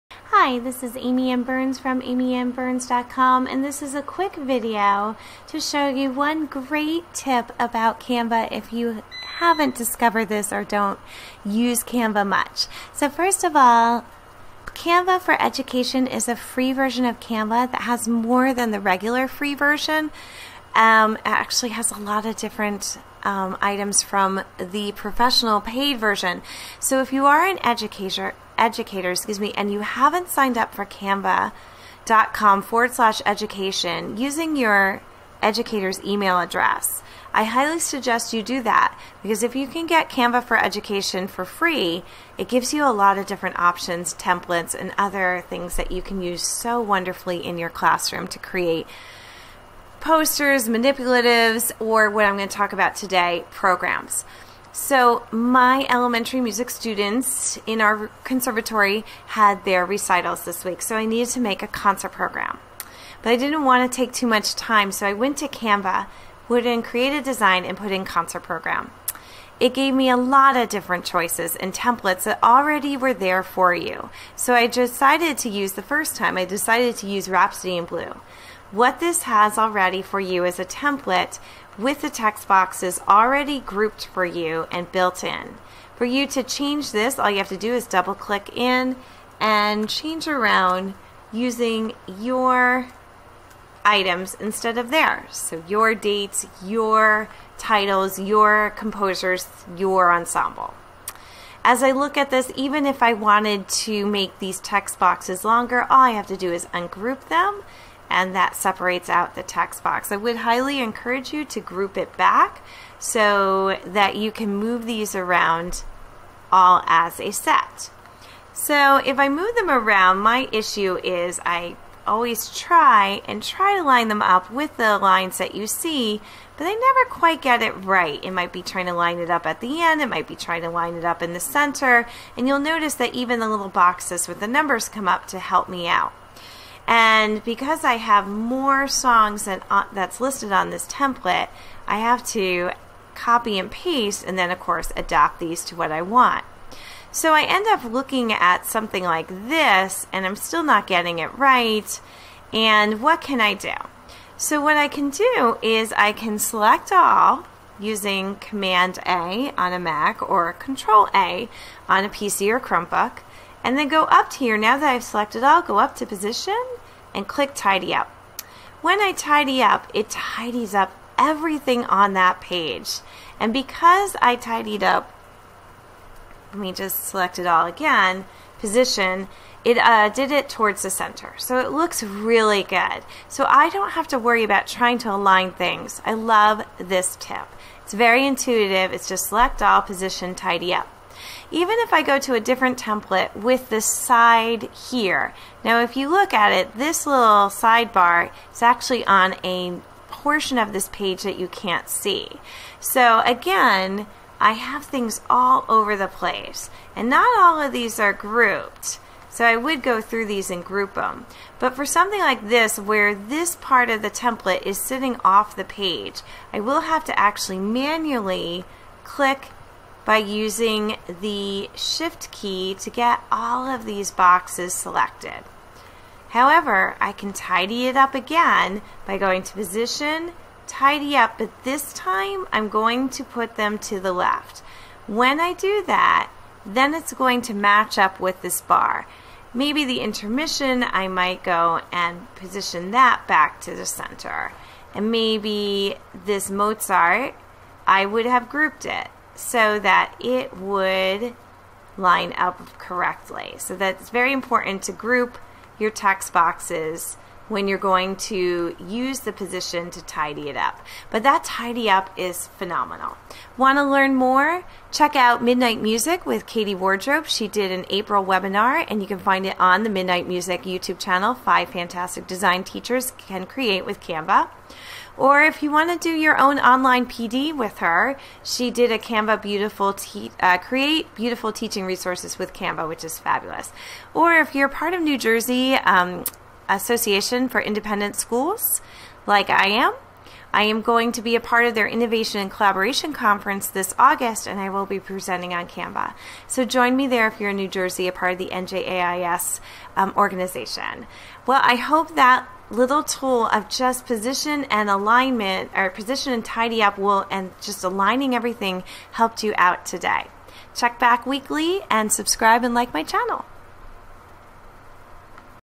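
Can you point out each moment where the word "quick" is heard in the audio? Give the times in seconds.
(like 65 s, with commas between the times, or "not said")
4 s.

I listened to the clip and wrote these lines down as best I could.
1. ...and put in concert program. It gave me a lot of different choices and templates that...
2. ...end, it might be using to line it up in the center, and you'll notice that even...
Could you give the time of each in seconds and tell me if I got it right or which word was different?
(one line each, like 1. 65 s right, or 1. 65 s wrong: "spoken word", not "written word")
1. 67 s right
2. 129 s wrong: "trying", not "using".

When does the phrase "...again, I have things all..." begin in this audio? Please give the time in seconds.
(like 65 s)
203 s.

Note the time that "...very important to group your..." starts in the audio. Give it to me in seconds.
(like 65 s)
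254 s.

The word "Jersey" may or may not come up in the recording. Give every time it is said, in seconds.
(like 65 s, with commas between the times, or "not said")
285 s, 297 s.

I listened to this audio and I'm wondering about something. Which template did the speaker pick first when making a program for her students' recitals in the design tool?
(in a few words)
Rhapsody in Blue.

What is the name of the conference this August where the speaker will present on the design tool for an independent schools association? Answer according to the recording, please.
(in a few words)
Innovation and Collaboration Conference.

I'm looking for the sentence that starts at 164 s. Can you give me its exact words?
Now that I've selected all, go up to position and click tidy up.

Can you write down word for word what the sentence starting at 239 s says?
Maybe the intermission, I might go and position that back to the center.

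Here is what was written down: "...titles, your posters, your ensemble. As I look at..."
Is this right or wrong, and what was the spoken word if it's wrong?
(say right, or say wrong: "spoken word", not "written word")
wrong: "composers", not "posters".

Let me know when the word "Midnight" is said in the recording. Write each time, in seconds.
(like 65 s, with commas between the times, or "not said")
265 s, 269 s.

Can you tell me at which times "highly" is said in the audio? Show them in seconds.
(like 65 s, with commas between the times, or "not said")
37 s, 110 s.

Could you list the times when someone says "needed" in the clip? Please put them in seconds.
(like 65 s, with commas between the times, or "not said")
61 s.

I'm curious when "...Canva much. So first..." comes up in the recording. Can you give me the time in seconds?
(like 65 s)
11 s.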